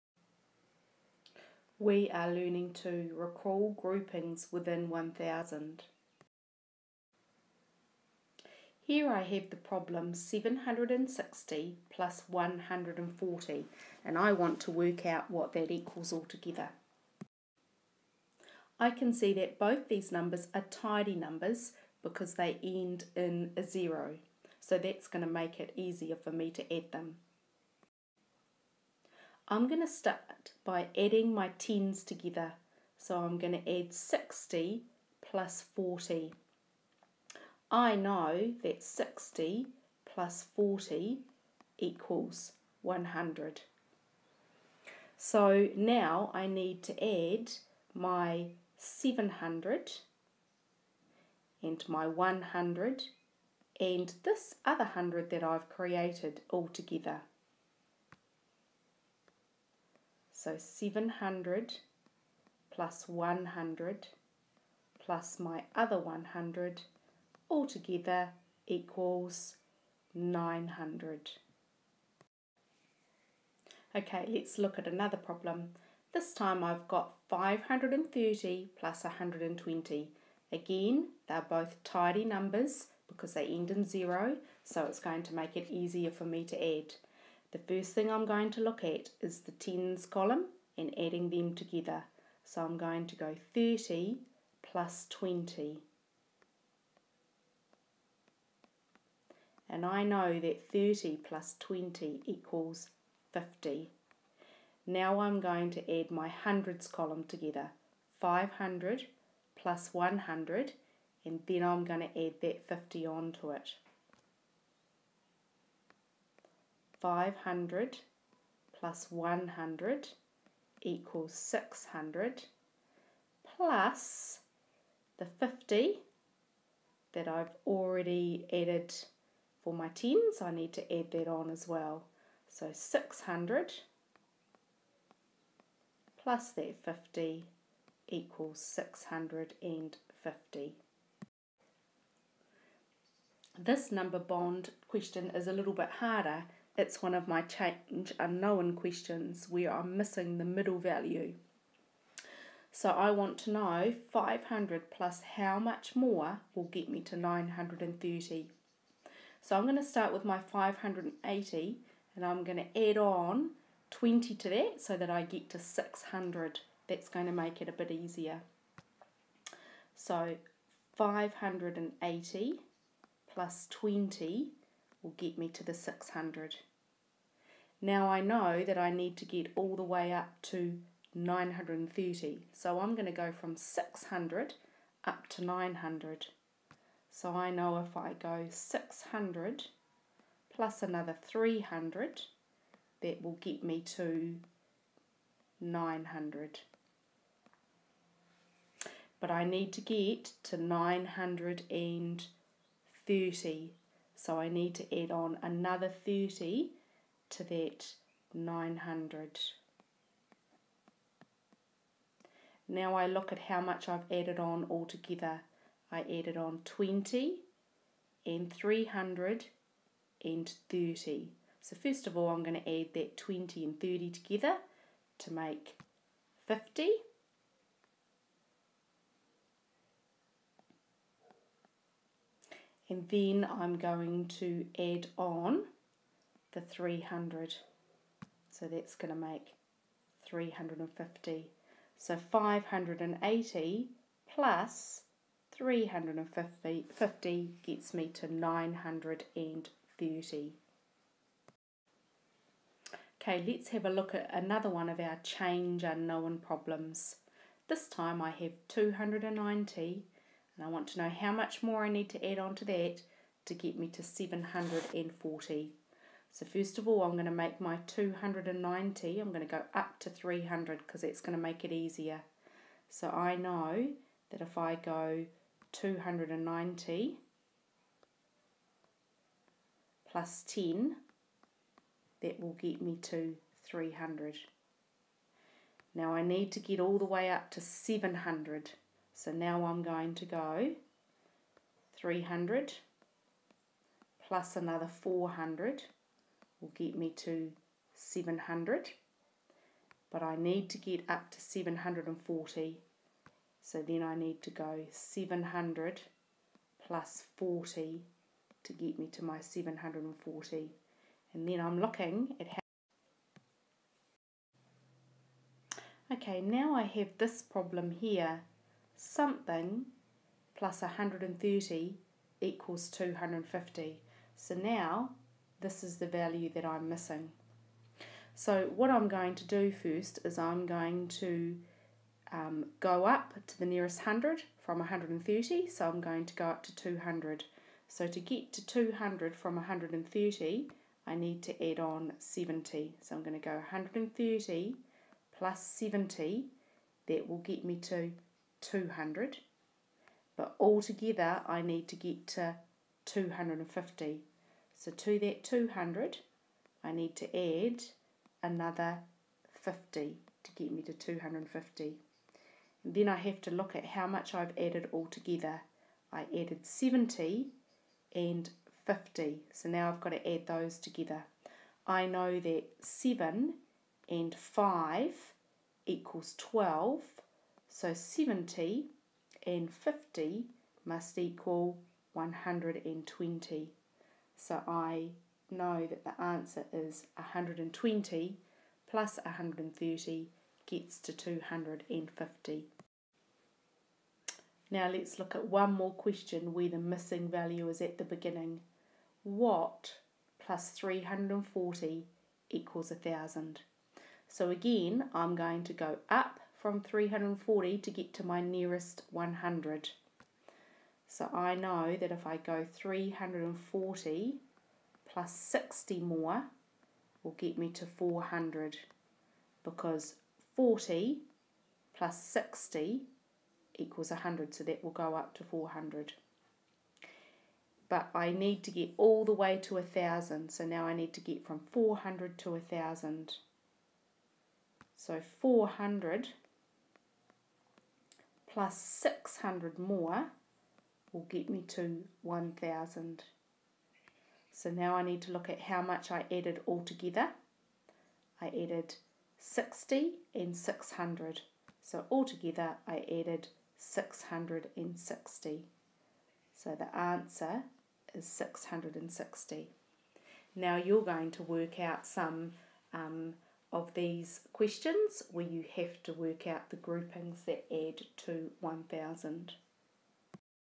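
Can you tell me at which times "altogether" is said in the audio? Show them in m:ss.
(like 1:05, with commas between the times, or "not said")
0:16, 1:07, 3:34, 5:50, 6:04, 7:26, 7:32.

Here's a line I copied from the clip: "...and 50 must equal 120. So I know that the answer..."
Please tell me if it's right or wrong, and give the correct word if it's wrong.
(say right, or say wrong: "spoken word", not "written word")
right.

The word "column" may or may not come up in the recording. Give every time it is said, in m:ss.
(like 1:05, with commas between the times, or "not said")
1:30, 1:46.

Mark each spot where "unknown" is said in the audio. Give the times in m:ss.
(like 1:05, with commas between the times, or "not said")
2:28, 4:15.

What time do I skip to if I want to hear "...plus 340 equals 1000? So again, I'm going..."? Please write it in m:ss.
6:40.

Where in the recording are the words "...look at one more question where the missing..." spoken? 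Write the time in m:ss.
6:35.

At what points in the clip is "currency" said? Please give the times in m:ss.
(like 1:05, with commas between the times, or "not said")
not said.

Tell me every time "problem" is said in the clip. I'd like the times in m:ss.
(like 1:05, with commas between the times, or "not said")
0:09, 1:15, 4:16, 5:17.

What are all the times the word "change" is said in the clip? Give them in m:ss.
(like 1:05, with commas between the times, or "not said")
2:27, 4:15.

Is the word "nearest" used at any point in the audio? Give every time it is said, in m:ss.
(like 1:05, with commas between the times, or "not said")
5:33, 6:48.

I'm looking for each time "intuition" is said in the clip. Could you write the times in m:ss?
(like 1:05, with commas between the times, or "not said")
not said.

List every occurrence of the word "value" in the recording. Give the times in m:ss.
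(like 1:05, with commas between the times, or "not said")
2:30, 5:26, 6:37.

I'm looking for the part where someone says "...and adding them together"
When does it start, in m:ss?
1:30.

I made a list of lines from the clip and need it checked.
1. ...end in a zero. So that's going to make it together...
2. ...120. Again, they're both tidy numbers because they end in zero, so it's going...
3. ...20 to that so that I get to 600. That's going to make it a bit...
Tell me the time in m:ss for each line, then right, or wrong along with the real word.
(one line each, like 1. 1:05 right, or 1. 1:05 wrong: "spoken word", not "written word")
1. 0:22 wrong: "easier", not "together"
2. 1:19 right
3. 2:43 right.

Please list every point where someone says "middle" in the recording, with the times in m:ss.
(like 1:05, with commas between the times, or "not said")
2:30.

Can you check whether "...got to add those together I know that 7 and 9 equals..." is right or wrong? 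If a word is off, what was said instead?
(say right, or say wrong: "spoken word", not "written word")
wrong: "5", not "9".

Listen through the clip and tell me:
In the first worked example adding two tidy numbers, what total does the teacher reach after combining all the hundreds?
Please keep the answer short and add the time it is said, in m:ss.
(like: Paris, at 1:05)
900, at 1:08.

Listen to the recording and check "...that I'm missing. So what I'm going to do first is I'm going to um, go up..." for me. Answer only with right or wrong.
right.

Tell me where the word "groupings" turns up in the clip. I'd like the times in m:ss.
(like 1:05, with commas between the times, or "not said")
0:03, 7:46.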